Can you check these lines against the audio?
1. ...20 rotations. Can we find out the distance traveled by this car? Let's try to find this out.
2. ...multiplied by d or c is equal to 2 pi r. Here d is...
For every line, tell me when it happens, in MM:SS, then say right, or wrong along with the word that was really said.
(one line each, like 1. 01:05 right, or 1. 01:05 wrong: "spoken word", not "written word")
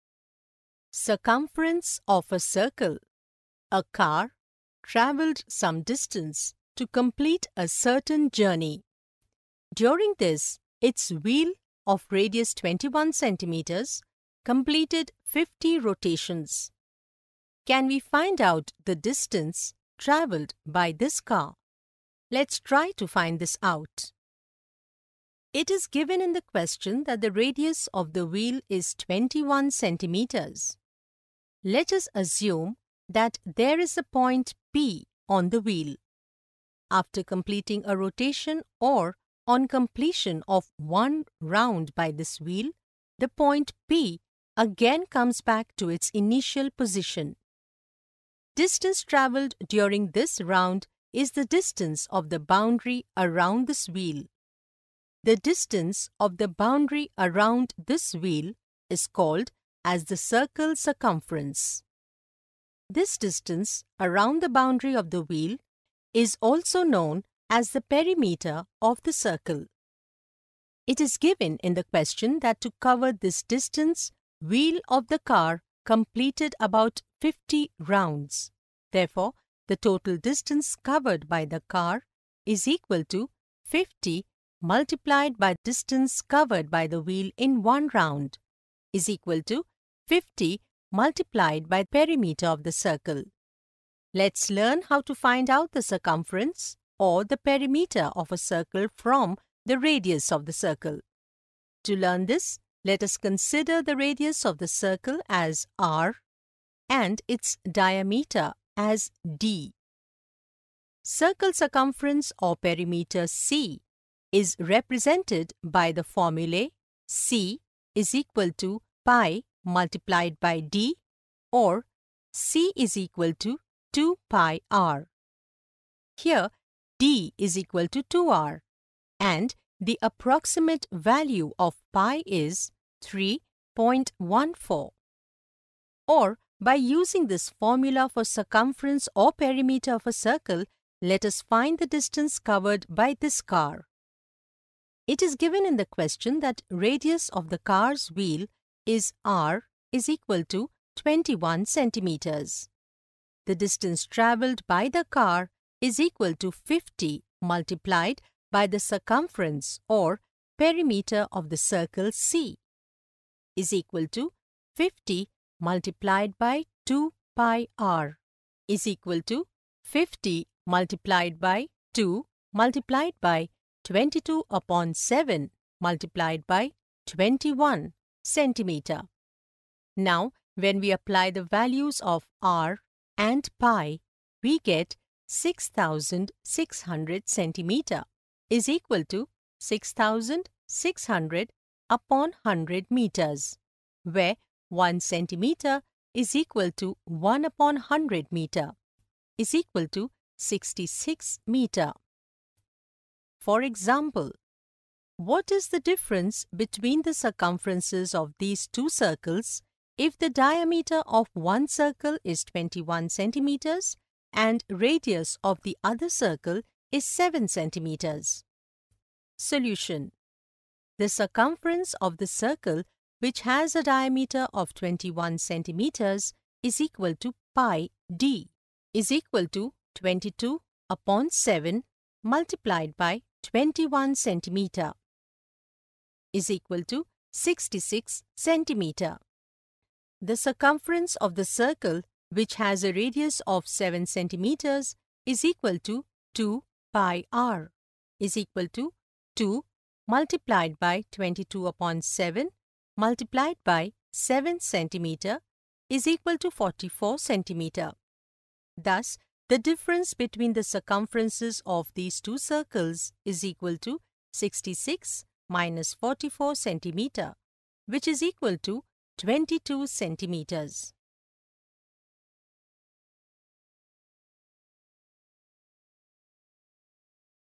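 1. 00:15 wrong: "50", not "20"
2. 01:59 right.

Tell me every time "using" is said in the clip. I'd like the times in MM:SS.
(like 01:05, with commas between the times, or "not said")
02:16.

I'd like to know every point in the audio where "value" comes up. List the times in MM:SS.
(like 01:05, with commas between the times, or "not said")
02:10, 03:01.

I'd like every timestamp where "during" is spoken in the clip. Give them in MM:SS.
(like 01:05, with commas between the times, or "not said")
00:09, 00:49.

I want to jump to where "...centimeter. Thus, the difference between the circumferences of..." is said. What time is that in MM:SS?
04:17.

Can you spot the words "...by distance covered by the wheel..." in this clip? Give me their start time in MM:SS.
01:25.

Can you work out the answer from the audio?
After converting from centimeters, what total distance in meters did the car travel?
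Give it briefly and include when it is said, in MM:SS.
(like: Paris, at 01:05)
66 meters, at 03:20.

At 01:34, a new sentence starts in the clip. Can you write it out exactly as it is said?
Let's learn how to find out the circumference or the perimeter of a circle from the radius of the circle.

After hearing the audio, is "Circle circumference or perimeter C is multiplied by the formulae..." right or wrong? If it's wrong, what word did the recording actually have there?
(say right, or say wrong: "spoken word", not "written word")
wrong: "represented", not "multiplied".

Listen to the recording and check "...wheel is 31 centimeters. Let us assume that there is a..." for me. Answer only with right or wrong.
wrong.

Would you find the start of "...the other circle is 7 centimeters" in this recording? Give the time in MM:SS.
03:35.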